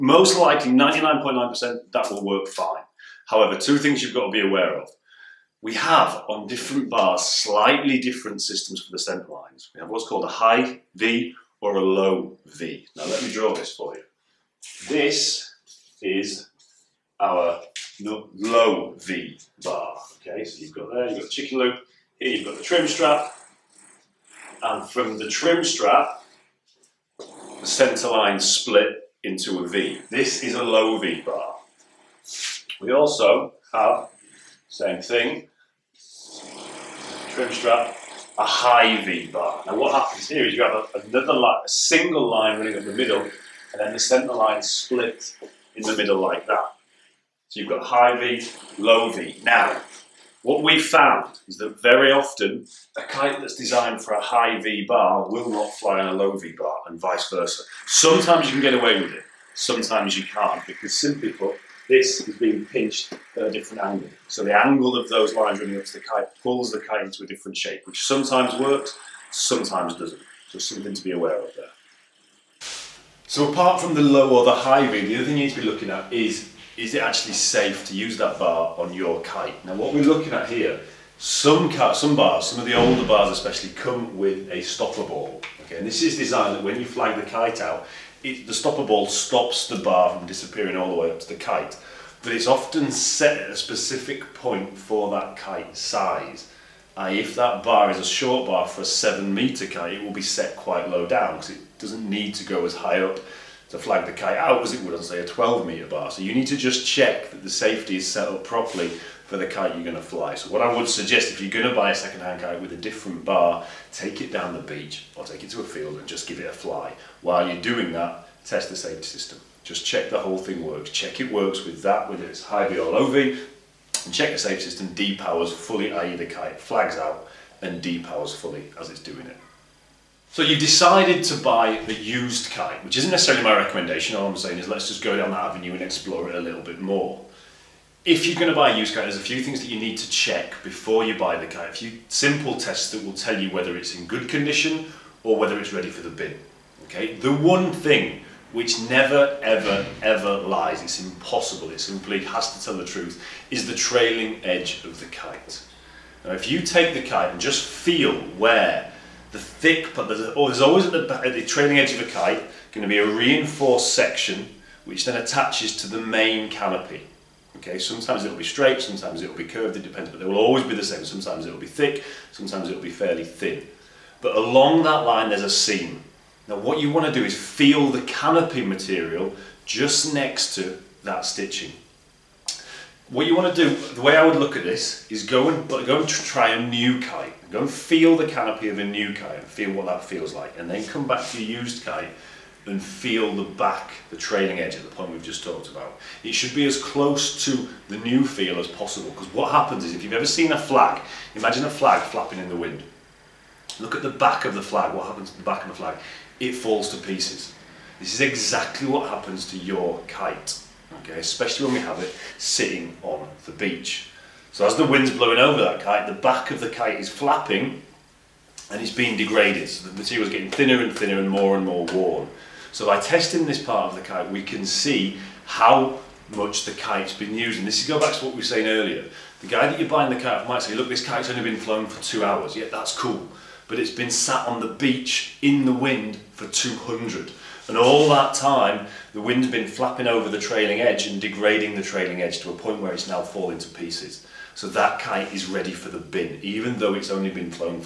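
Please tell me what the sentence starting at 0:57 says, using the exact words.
Sometimes you can get away with it, sometimes you can't because simply put, this is being pinched at a different angle.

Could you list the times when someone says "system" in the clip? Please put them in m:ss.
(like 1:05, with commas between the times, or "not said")
0:08, 1:59, 2:04.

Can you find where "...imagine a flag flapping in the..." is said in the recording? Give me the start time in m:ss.
3:21.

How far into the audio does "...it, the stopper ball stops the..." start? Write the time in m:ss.
1:28.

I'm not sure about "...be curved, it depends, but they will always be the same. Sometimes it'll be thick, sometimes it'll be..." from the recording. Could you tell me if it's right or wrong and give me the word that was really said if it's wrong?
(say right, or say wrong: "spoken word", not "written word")
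right.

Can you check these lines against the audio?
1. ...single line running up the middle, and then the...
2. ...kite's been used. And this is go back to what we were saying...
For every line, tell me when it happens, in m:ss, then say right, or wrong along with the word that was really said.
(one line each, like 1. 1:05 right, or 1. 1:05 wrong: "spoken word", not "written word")
1. 0:41 right
2. 3:46 right.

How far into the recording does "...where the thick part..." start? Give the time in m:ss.
2:38.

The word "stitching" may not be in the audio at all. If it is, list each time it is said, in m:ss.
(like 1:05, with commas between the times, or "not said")
3:01.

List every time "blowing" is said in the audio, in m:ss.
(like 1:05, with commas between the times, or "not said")
3:35.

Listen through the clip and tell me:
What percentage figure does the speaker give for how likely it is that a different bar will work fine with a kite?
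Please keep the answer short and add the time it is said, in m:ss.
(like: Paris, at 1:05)
99.9%, at 0:00.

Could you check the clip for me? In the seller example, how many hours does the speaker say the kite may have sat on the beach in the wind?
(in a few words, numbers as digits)
200.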